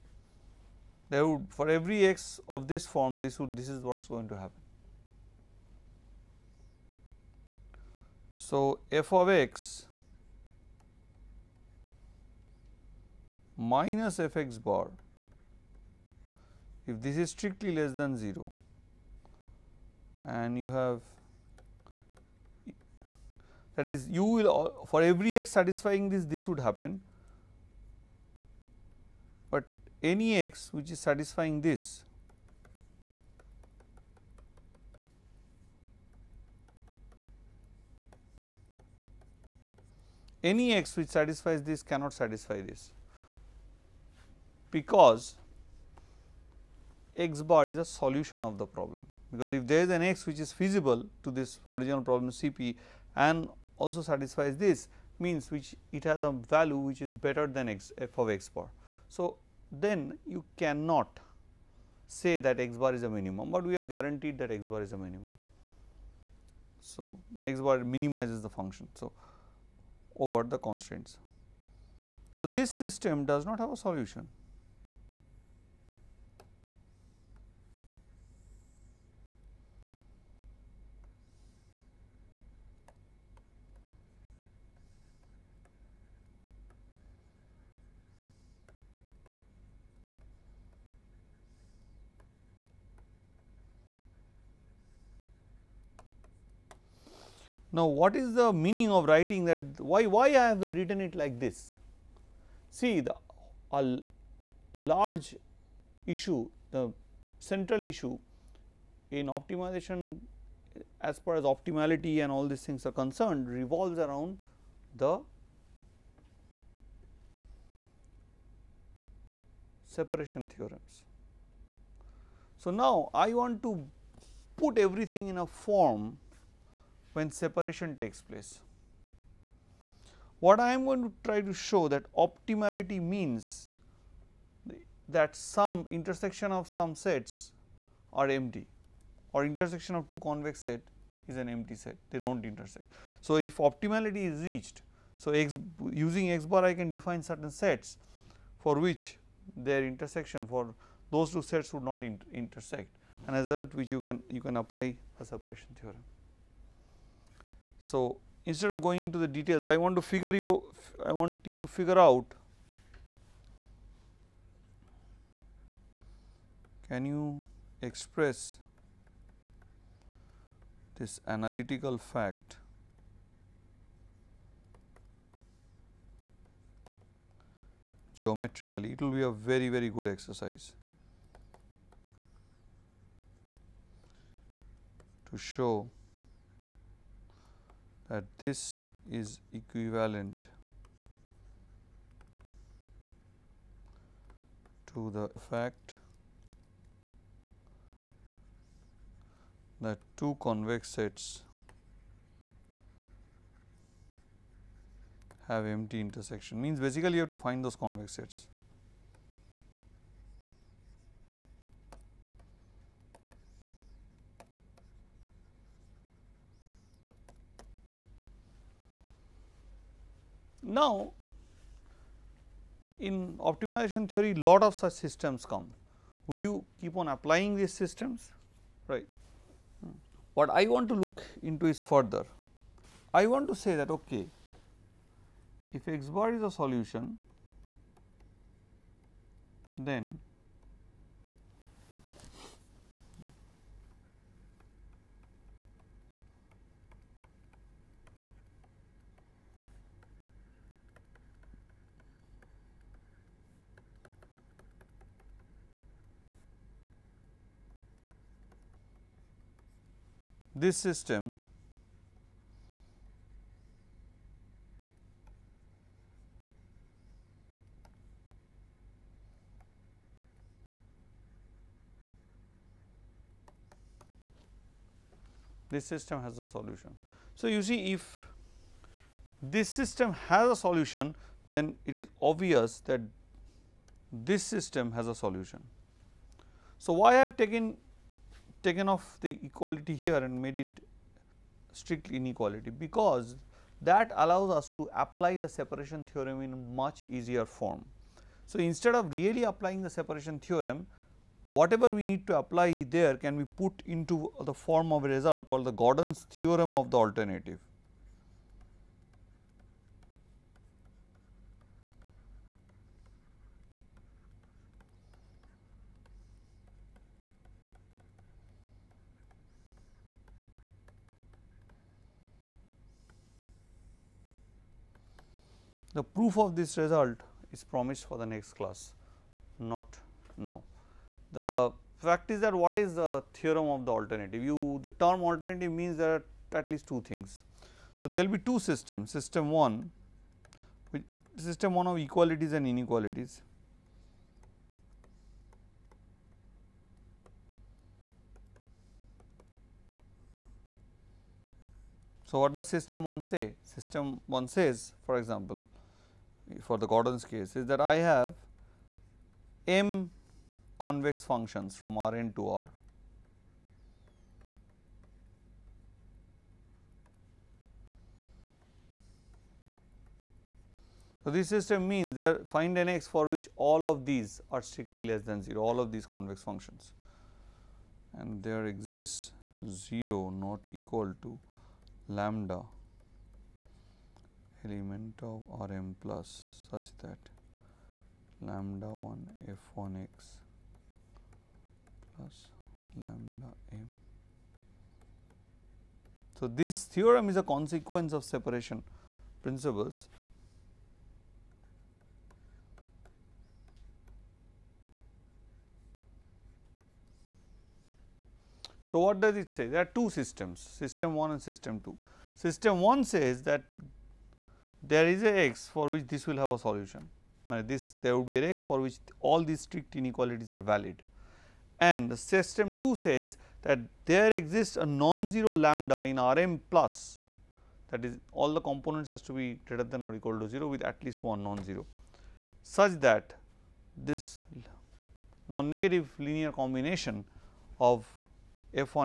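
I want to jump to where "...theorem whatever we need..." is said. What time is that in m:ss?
5:00.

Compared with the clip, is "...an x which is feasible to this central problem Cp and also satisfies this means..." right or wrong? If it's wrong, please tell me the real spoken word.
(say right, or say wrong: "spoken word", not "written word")
wrong: "original", not "central".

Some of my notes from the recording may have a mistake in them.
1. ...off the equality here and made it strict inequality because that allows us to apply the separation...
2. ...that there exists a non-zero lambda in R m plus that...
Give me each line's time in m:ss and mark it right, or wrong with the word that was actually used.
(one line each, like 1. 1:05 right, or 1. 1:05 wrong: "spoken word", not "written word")
1. 4:48 right
2. 7:03 right.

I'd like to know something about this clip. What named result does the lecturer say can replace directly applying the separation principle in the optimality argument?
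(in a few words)
Gordan's theorem of the alternative.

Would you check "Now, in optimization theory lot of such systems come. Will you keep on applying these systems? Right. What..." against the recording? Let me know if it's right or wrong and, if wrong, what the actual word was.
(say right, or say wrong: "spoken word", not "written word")
right.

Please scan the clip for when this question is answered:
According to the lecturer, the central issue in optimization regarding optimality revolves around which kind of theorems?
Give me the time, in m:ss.
1:59.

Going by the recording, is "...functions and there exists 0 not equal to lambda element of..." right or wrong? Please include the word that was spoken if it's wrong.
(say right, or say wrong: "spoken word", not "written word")
right.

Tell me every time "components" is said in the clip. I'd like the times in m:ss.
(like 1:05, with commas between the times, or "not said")
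7:08.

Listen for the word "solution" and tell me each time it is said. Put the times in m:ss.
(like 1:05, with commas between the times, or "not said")
0:47, 1:13, 3:56, 4:36, 4:40, 4:45, 6:56.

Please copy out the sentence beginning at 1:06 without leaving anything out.
So, x bar minimizes the function.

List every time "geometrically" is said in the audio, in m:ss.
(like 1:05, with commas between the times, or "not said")
2:58.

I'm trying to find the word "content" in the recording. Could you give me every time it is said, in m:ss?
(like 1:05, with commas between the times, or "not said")
not said.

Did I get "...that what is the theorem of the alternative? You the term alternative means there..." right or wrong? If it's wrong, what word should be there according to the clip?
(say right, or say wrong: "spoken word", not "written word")
right.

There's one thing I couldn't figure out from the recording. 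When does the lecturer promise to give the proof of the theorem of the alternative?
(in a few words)
Next class.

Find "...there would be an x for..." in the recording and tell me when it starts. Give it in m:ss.
6:58.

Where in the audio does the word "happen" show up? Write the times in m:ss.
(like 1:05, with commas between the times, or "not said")
0:04, 0:26.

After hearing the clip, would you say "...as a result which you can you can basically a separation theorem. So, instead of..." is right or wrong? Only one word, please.
wrong.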